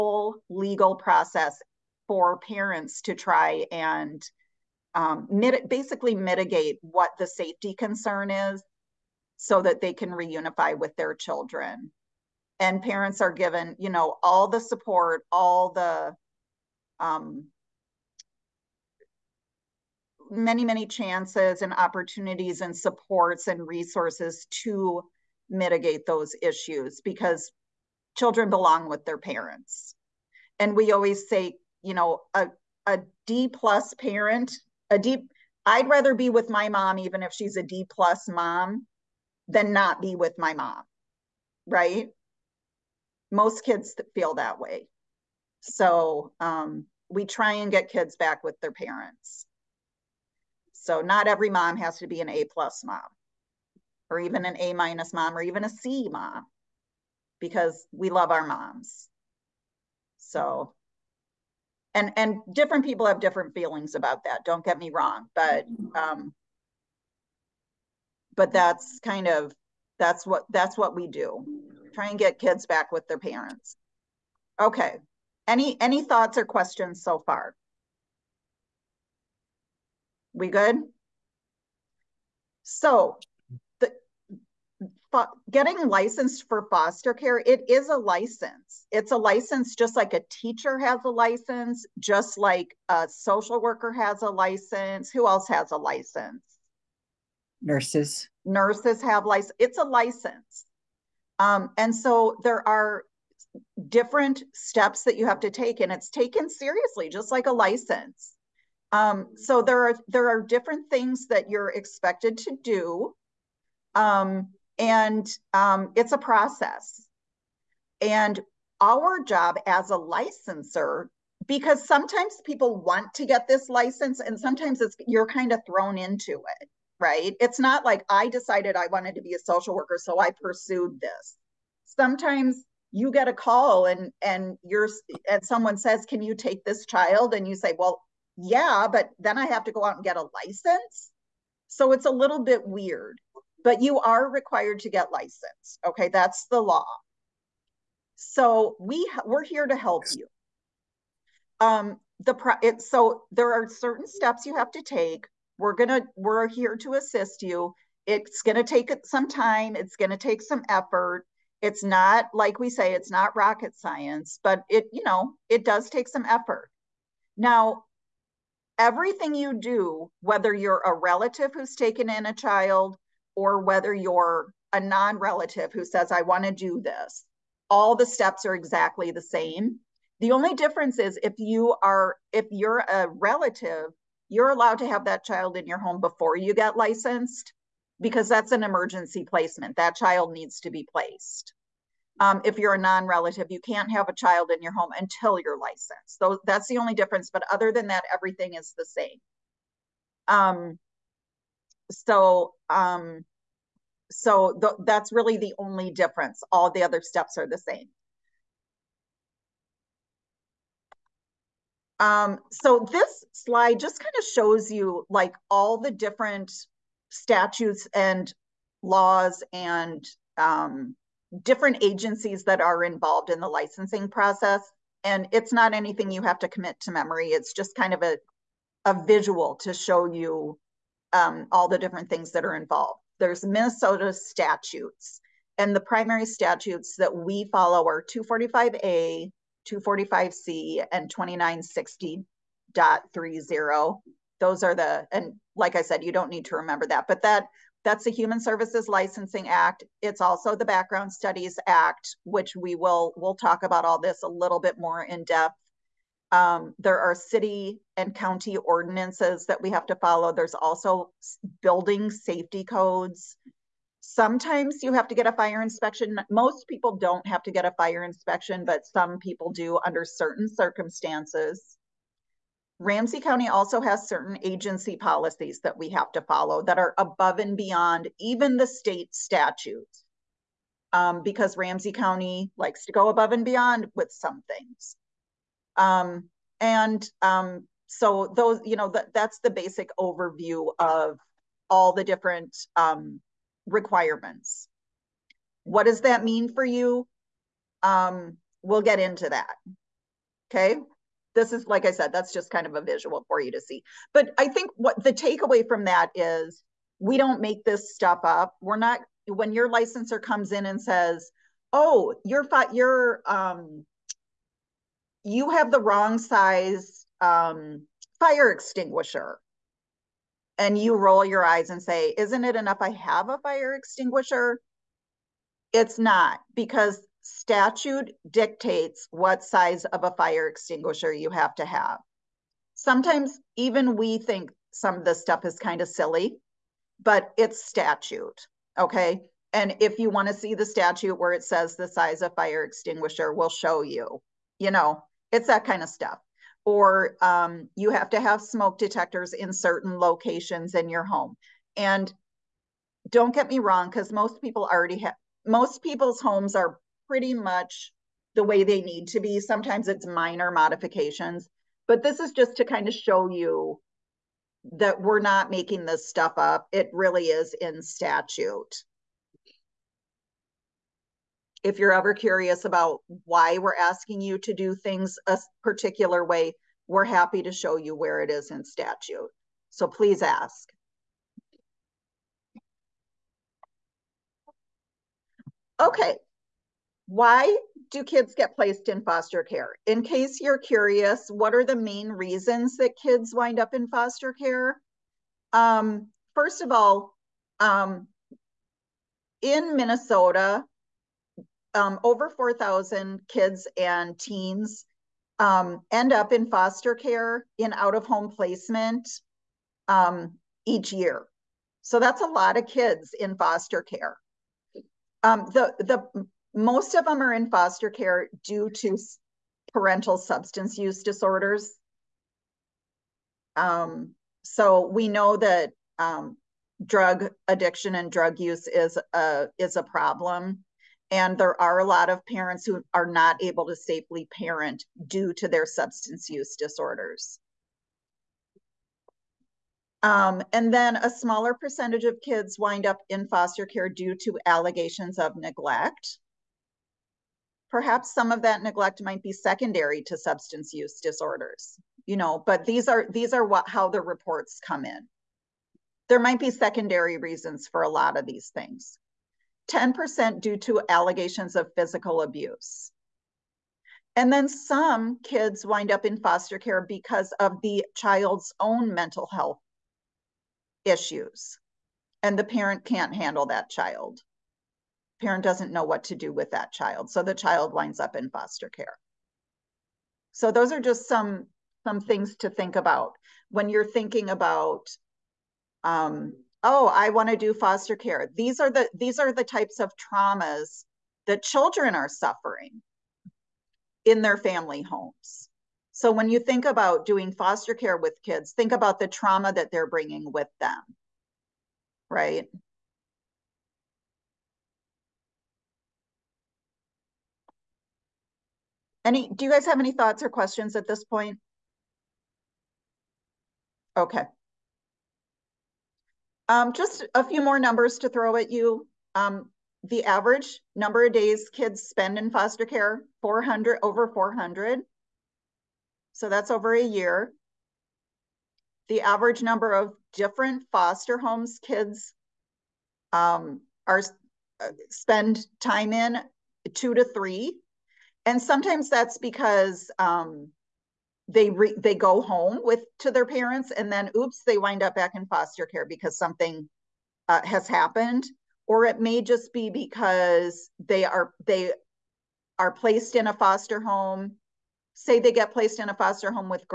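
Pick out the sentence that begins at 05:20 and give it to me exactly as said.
And you roll your eyes and say, Isn't it enough I have a fire extinguisher?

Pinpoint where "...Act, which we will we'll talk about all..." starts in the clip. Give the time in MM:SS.
04:11.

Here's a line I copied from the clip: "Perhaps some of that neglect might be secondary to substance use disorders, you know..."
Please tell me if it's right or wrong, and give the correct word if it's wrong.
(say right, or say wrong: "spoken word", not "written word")
right.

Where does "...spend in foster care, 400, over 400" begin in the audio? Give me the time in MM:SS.
08:41.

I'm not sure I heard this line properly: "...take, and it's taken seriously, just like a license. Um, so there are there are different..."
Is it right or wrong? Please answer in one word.
right.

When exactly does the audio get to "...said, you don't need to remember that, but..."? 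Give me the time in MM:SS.
04:05.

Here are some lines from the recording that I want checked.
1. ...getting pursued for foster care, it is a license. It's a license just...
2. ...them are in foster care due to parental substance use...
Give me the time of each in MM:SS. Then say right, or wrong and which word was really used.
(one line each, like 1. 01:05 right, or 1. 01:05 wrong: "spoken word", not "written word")
1. 01:25 wrong: "licensed", not "pursued"
2. 06:57 right.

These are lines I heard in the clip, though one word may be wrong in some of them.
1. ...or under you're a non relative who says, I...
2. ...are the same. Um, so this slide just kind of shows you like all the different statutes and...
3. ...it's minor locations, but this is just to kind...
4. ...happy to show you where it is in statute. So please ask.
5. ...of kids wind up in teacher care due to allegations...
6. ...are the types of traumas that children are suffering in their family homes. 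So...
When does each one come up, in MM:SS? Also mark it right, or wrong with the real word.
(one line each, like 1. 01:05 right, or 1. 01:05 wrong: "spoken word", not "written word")
1. 02:53 wrong: "whether", not "under"
2. 03:27 right
3. 05:59 wrong: "modifications", not "locations"
4. 06:17 right
5. 07:22 wrong: "foster", not "teacher"
6. 08:09 right.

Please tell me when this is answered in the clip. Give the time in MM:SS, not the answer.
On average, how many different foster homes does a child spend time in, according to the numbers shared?
08:56.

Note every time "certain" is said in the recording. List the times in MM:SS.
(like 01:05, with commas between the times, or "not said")
02:33, 04:30, 04:34, 05:49.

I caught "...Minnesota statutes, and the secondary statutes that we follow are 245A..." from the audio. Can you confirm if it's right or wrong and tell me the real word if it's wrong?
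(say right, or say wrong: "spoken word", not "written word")
wrong: "primary", not "secondary".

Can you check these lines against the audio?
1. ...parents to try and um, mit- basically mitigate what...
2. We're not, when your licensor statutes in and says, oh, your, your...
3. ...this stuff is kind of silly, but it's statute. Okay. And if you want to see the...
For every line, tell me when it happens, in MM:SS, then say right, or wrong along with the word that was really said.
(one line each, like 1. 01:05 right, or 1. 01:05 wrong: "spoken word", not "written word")
1. 00:02 right
2. 05:08 wrong: "comes", not "statutes"
3. 05:35 right.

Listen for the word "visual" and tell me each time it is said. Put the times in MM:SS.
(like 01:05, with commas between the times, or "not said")
03:49, 05:02.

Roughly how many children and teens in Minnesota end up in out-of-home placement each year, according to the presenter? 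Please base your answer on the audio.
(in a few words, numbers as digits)
Over 4,000.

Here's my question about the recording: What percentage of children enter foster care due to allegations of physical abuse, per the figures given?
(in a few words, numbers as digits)
10%.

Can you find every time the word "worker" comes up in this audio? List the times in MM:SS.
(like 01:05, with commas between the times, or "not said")
01:33, 02:09.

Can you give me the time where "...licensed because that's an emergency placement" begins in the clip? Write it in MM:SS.
03:06.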